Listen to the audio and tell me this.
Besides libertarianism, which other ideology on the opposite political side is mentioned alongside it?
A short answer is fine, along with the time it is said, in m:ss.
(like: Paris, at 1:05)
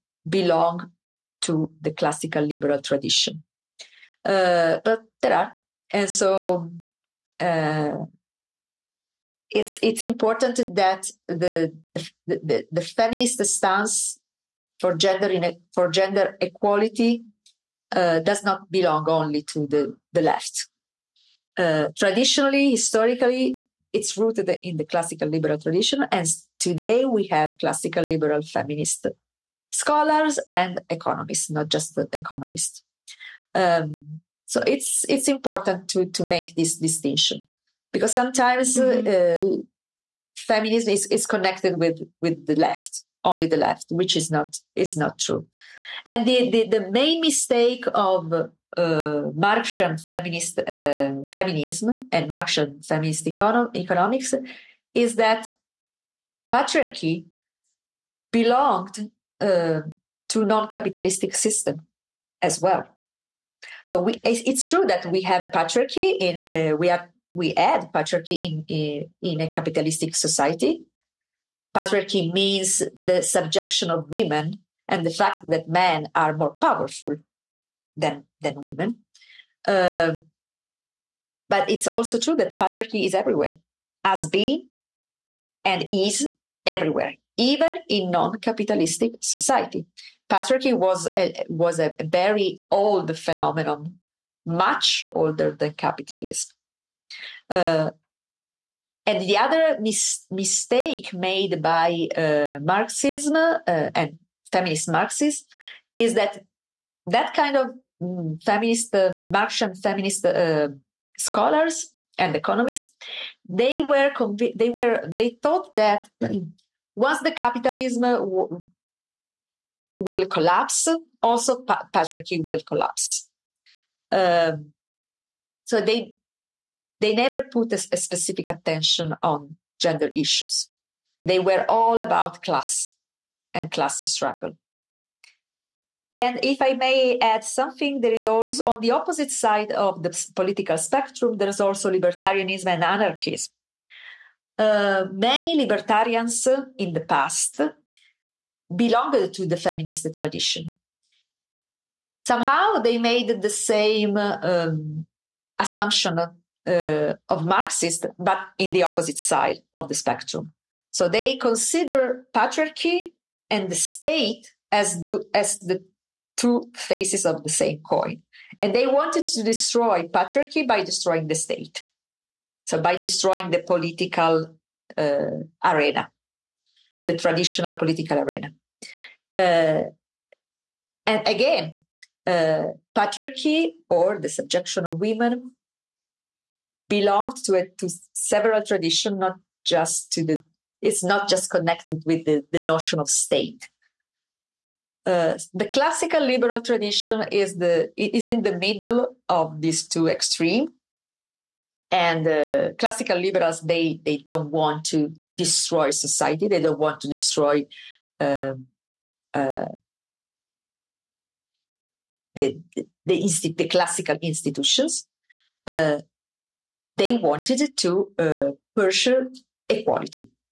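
Anarchism, at 2:22.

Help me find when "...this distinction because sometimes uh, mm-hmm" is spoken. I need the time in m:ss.
0:36.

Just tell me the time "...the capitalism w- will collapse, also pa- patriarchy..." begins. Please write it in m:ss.
1:57.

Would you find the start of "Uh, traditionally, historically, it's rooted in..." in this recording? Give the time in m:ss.
0:21.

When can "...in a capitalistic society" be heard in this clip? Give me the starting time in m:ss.
1:09.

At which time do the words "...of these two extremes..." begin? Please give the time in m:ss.
3:19.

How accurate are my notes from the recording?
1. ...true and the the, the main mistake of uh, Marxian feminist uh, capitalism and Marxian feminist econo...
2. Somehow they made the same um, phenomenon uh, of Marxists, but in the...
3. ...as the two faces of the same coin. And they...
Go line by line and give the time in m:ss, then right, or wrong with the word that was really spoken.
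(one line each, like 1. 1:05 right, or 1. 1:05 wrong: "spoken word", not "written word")
1. 0:45 wrong: "feminism", not "capitalism"
2. 2:32 wrong: "assumption", not "phenomenon"
3. 2:45 right.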